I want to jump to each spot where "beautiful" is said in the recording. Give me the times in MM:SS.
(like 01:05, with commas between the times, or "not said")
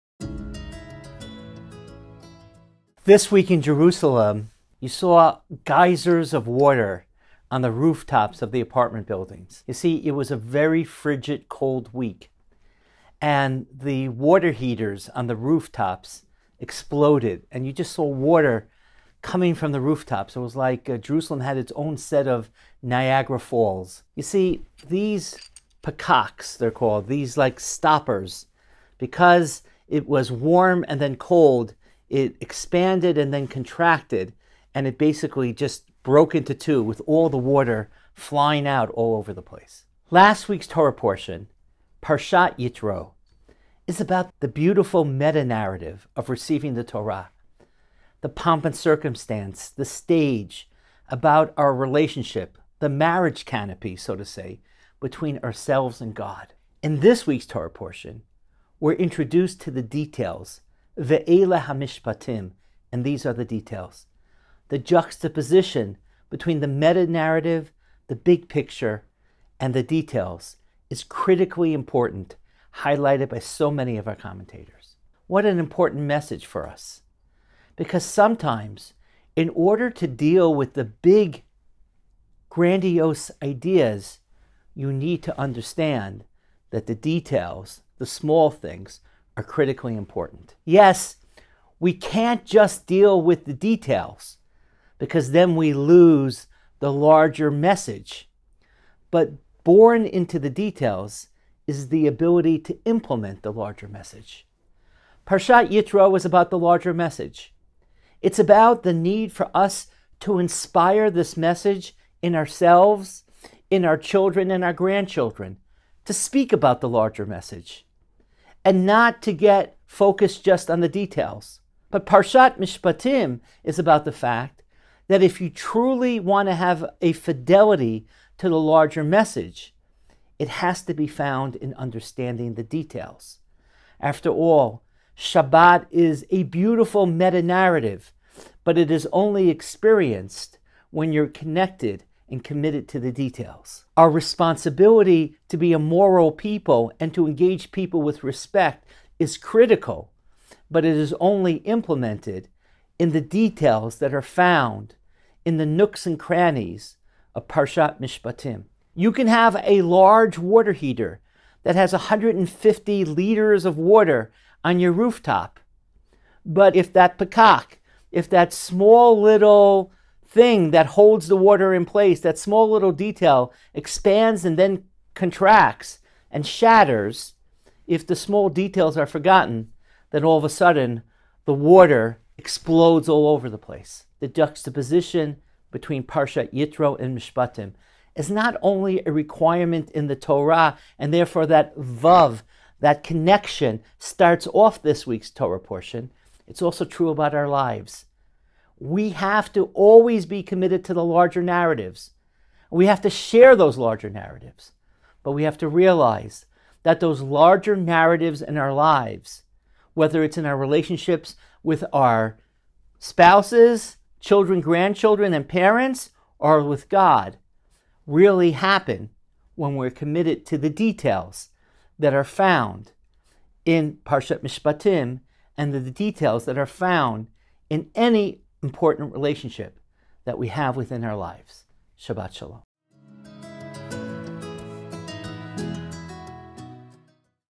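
00:44, 02:16.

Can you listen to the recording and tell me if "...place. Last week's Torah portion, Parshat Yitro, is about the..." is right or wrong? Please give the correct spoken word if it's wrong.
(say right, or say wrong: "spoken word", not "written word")
right.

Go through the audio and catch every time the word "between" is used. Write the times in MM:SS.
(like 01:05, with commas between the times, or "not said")
00:54, 01:06, 03:05.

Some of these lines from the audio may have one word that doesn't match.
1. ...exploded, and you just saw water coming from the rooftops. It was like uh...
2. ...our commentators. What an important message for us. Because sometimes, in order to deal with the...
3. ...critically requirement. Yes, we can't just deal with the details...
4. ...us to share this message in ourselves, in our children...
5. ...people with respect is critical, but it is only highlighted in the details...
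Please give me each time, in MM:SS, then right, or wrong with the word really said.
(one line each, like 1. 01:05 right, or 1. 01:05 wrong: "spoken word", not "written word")
1. 00:16 right
2. 01:14 right
3. 01:29 wrong: "important", not "requirement"
4. 01:49 wrong: "inspire", not "share"
5. 02:27 wrong: "implemented", not "highlighted".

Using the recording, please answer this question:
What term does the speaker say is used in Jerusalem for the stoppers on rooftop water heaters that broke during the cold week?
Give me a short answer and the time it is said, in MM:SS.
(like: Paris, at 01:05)
pakaks, at 00:25.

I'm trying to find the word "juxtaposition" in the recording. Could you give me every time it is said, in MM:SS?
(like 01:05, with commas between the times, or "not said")
01:04, 03:04.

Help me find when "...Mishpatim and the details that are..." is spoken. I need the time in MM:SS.
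03:44.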